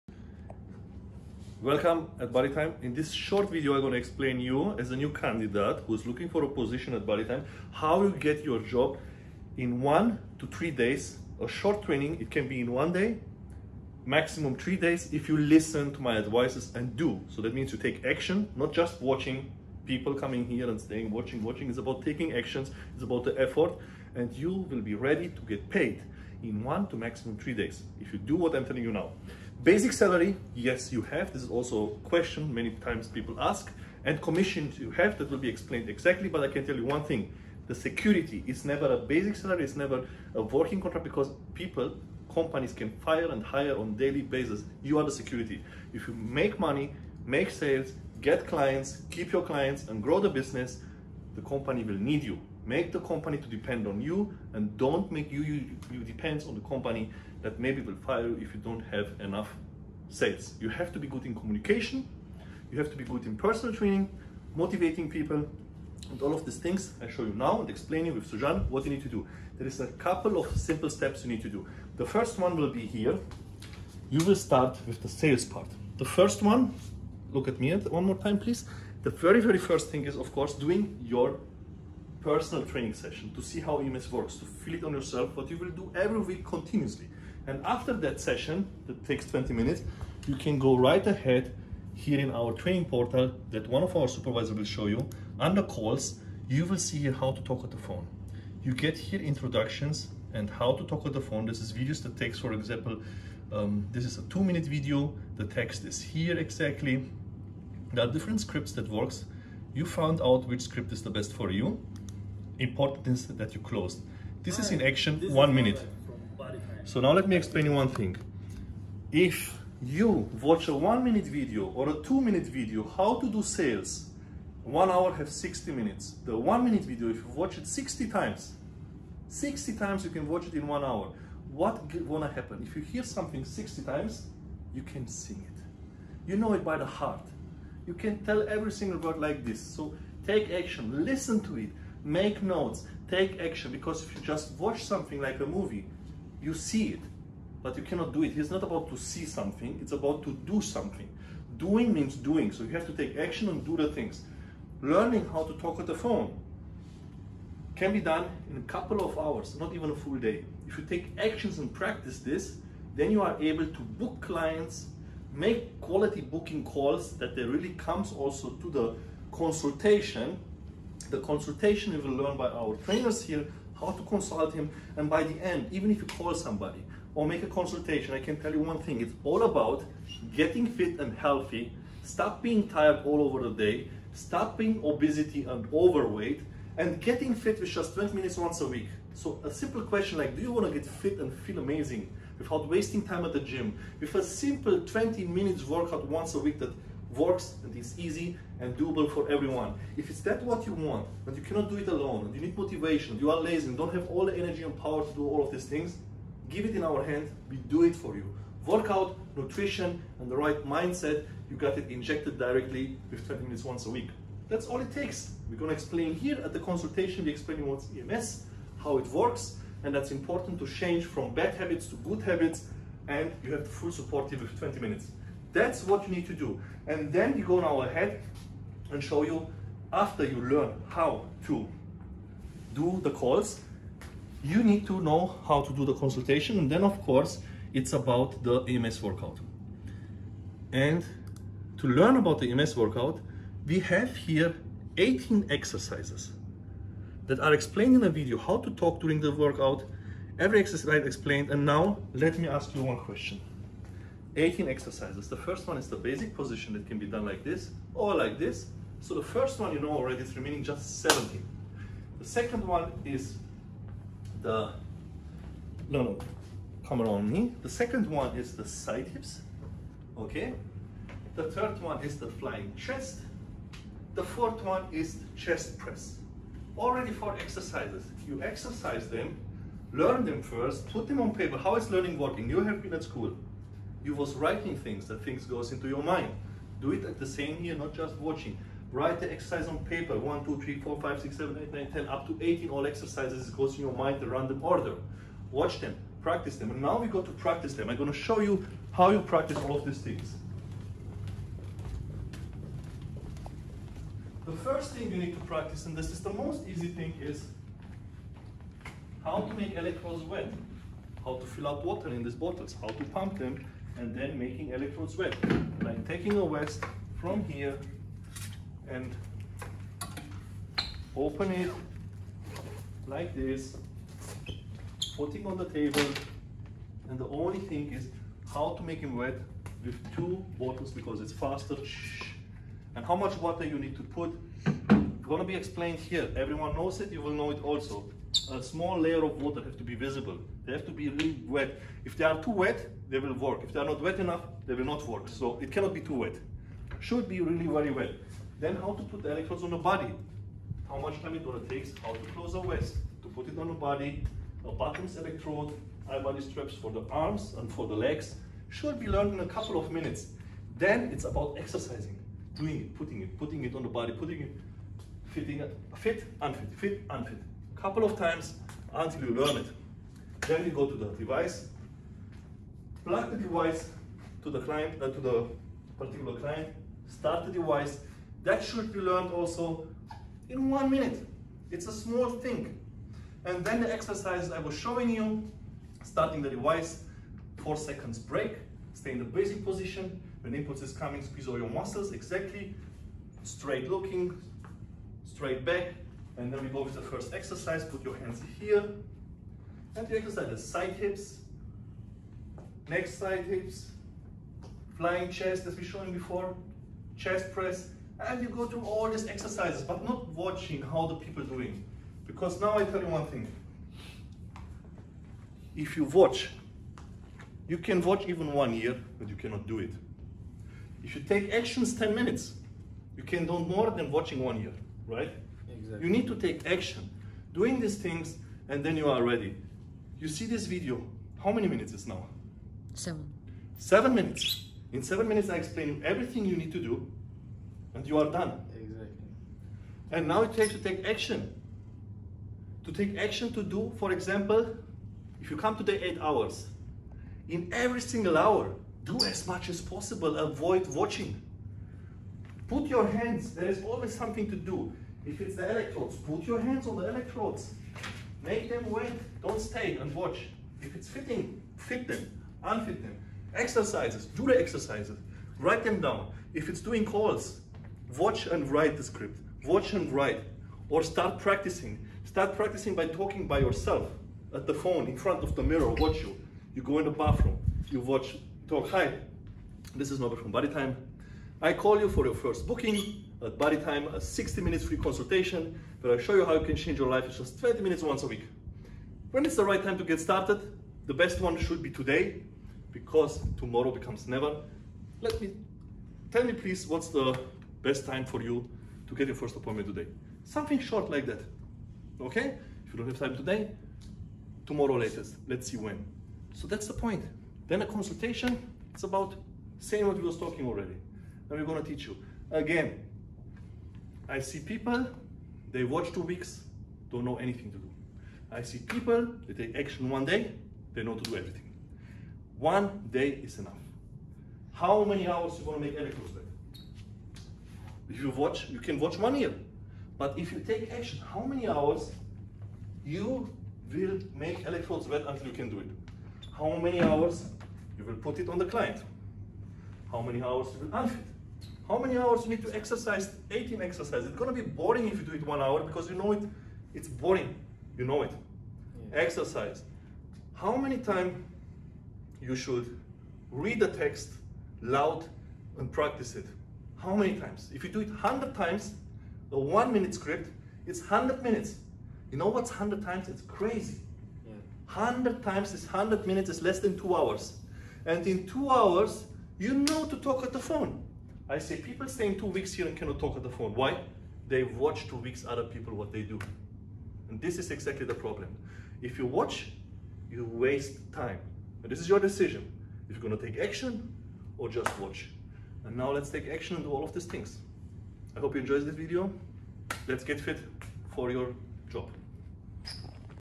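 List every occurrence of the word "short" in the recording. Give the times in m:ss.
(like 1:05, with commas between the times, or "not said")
0:03, 0:11, 8:20.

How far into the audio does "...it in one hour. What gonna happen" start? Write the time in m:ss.
2:10.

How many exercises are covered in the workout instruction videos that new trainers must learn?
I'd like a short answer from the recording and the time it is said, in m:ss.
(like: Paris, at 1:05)
18, at 4:03.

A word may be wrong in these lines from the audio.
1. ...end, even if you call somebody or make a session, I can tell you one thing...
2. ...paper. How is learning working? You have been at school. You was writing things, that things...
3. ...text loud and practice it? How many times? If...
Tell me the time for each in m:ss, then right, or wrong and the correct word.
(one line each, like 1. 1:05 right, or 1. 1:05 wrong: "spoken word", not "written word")
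1. 2:55 wrong: "consultation", not "session"
2. 4:41 right
3. 9:13 right.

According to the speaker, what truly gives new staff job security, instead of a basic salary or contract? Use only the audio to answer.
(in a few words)
You are the security.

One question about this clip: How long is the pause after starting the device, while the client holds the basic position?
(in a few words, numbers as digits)
Four seconds.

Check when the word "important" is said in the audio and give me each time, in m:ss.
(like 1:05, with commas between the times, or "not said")
1:52, 3:40.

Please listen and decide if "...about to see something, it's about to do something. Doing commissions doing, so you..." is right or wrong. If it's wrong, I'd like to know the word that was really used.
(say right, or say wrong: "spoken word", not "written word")
wrong: "means", not "commissions".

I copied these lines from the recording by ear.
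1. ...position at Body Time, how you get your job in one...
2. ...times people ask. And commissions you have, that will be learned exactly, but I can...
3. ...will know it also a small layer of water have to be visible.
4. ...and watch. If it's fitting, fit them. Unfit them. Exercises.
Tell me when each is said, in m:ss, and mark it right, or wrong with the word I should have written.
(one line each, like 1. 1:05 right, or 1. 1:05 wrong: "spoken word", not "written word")
1. 0:06 right
2. 0:32 wrong: "explained", not "learned"
3. 5:37 right
4. 7:39 right.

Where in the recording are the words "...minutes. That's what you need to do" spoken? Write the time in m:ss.
3:44.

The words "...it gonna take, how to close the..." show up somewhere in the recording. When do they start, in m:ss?
5:51.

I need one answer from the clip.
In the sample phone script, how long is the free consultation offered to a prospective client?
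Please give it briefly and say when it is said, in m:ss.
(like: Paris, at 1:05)
60 minutes, at 8:04.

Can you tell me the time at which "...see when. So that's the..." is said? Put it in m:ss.
8:25.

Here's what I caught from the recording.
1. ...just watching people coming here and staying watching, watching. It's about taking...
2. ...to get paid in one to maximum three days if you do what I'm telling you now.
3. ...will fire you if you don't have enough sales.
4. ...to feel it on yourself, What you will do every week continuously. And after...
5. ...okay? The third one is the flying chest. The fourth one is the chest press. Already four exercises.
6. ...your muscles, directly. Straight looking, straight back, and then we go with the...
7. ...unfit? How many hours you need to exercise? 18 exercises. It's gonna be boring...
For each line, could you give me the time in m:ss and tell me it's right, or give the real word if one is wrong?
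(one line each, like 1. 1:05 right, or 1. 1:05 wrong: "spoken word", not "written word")
1. 0:18 right
2. 0:25 right
3. 0:57 right
4. 1:24 right
5. 4:30 right
6. 6:31 wrong: "exactly", not "directly"
7. 9:00 right.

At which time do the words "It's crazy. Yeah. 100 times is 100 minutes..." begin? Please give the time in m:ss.
9:23.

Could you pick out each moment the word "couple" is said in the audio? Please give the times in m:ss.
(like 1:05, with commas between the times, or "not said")
1:09, 2:38, 5:59, 6:07.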